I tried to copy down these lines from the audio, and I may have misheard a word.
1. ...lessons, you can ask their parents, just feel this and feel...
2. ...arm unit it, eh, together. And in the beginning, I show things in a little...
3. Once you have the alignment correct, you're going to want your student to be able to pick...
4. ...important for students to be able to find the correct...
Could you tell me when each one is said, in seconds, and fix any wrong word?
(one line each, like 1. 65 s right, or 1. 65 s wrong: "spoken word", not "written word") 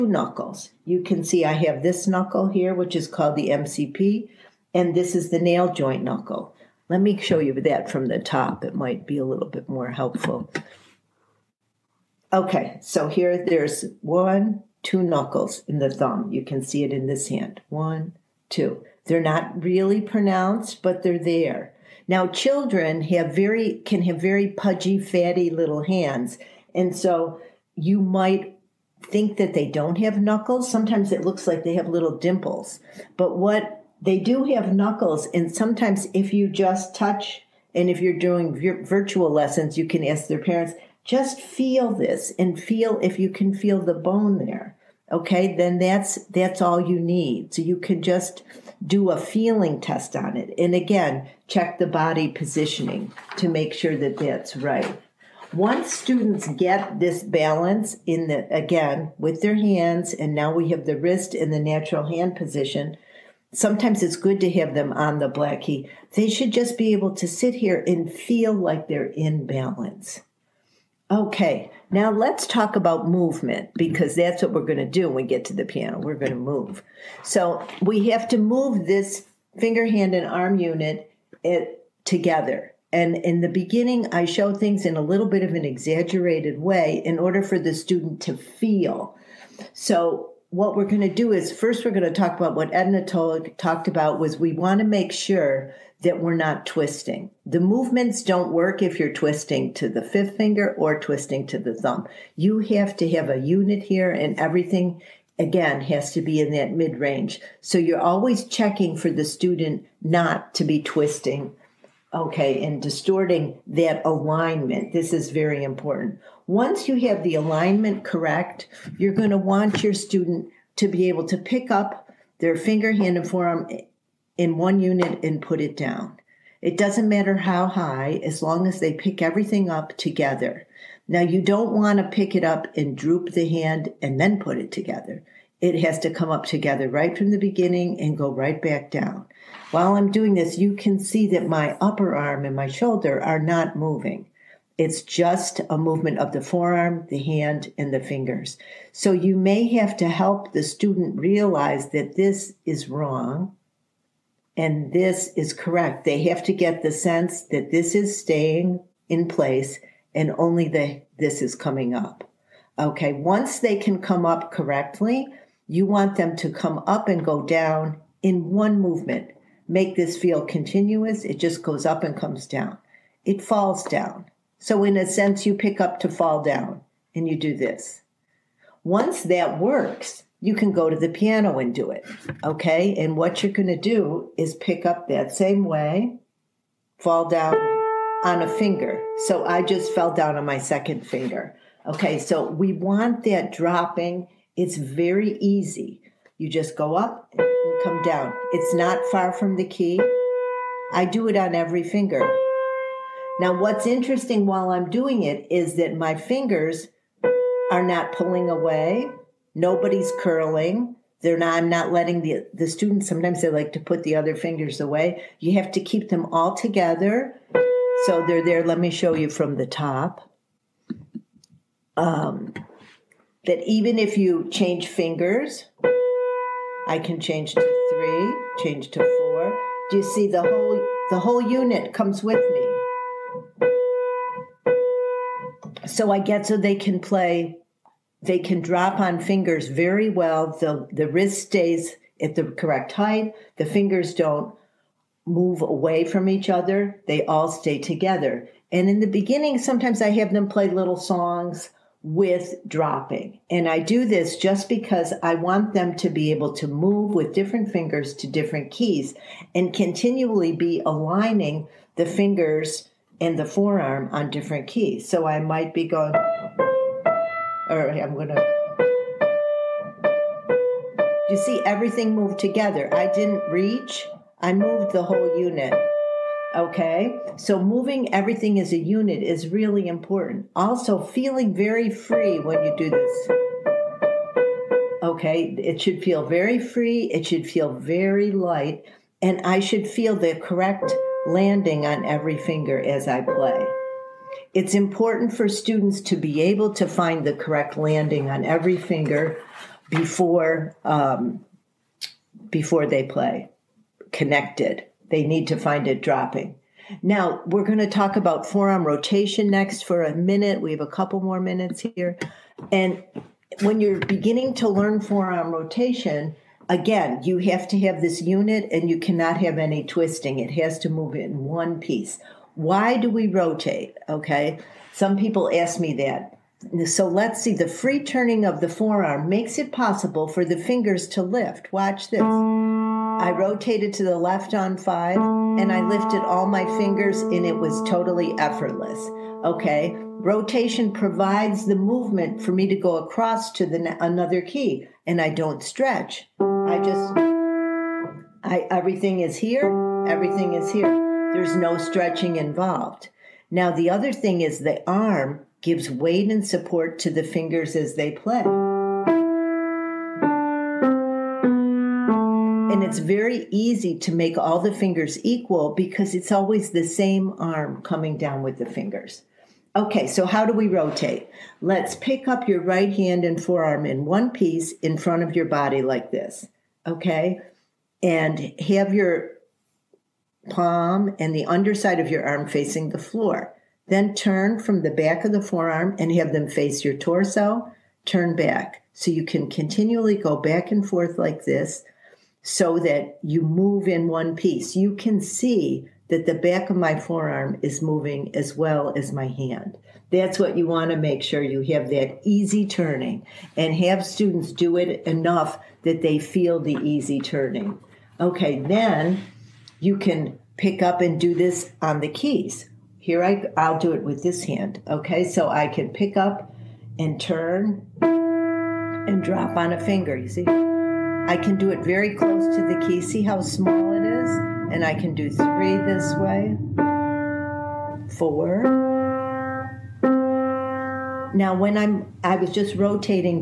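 1. 39 s right
2. 80 s right
3. 116 s right
4. 294 s right.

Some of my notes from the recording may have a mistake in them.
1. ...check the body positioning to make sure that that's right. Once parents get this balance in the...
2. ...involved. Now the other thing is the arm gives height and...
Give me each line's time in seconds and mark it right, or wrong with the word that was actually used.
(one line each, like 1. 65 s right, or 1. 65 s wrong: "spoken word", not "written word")
1. 51 s wrong: "students", not "parents"
2. 352 s wrong: "weight", not "height".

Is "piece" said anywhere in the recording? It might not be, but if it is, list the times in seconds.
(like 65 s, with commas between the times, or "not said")
321 s, 374 s, 394 s.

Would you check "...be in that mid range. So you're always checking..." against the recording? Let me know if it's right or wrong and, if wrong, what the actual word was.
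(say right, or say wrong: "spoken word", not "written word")
right.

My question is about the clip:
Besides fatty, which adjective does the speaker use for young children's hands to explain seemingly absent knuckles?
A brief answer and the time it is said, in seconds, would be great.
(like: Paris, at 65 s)
pudgy, at 24 s.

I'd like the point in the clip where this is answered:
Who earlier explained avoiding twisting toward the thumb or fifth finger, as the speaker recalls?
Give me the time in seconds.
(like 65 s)
92 s.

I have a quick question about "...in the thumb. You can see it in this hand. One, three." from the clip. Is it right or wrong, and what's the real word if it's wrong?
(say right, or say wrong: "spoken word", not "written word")
wrong: "two", not "three".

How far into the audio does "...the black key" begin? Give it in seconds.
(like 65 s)
65 s.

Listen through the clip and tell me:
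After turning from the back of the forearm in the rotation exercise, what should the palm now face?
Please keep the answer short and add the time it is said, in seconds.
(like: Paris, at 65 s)
your torso, at 386 s.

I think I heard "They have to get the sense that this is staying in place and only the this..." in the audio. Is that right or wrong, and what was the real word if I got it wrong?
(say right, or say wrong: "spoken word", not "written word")
right.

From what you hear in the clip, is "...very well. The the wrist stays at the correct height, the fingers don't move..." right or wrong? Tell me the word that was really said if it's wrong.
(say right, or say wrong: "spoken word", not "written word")
right.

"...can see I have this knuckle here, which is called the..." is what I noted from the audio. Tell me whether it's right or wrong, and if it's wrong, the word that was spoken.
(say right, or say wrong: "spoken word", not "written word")
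right.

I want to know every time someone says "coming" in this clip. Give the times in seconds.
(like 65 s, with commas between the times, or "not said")
161 s, 367 s.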